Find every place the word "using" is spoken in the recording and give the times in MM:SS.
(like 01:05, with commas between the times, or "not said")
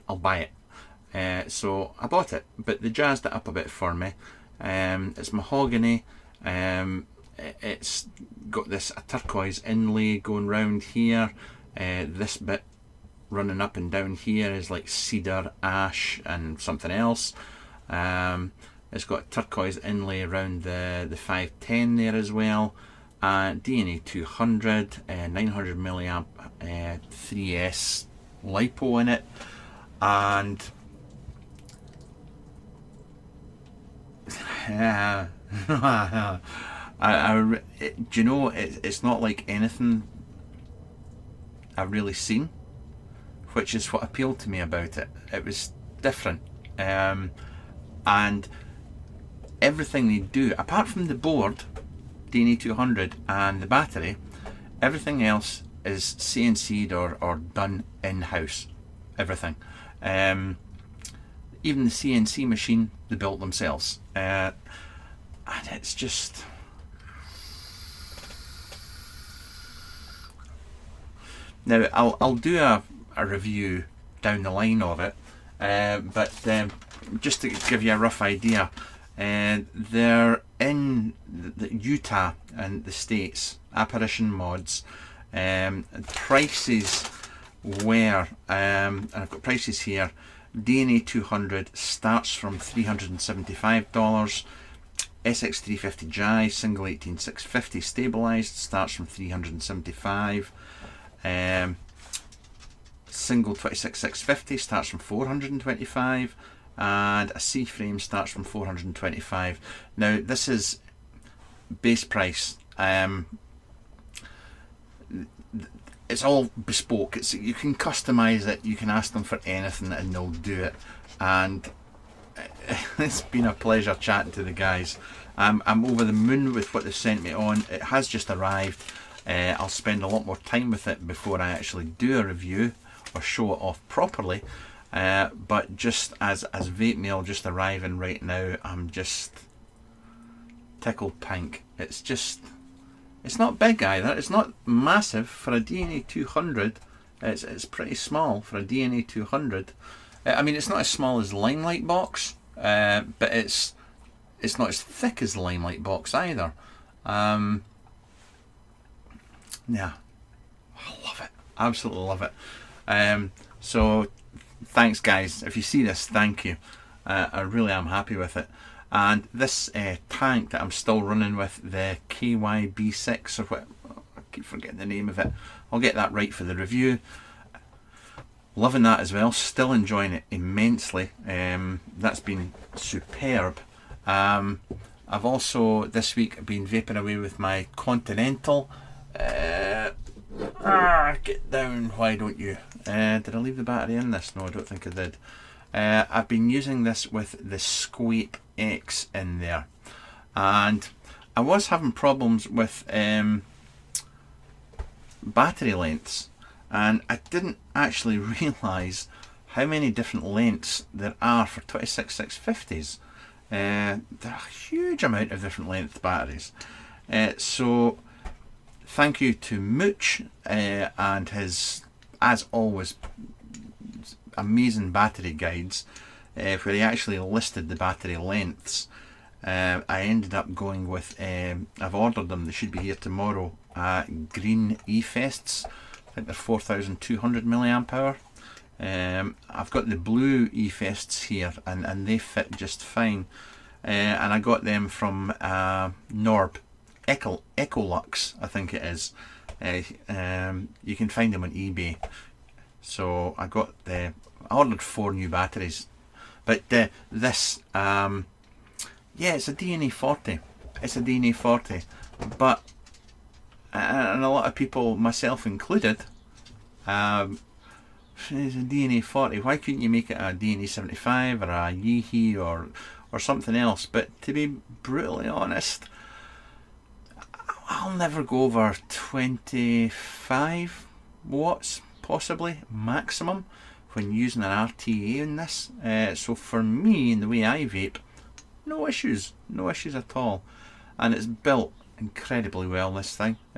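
03:16, 04:44.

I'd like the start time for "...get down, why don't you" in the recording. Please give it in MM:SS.
03:11.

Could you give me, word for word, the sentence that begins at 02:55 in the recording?
I'll get that right for the review.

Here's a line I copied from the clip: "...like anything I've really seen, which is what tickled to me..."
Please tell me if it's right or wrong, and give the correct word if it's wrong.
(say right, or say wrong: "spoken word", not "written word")
wrong: "appealed", not "tickled".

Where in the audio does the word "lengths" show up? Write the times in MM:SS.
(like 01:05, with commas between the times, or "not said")
03:25, 03:30, 03:35, 03:48.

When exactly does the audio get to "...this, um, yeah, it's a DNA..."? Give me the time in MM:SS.
04:17.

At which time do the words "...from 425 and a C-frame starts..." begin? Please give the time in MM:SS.
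01:44.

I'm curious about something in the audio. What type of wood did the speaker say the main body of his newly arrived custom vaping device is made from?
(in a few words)
Mahogany.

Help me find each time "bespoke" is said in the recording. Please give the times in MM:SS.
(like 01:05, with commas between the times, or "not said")
01:56.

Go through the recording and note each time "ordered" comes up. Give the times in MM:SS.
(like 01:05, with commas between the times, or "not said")
03:51, 04:14.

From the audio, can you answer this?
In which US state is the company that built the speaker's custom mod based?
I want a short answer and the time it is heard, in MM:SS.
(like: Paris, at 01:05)
Utah, at 01:21.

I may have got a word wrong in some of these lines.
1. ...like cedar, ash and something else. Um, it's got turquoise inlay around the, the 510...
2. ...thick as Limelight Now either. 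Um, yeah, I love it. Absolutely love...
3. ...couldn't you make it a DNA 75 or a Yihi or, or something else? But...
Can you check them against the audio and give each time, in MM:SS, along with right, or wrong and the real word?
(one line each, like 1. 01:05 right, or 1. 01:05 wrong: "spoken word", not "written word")
1. 00:14 right
2. 02:34 wrong: "Box", not "Now"
3. 04:29 right.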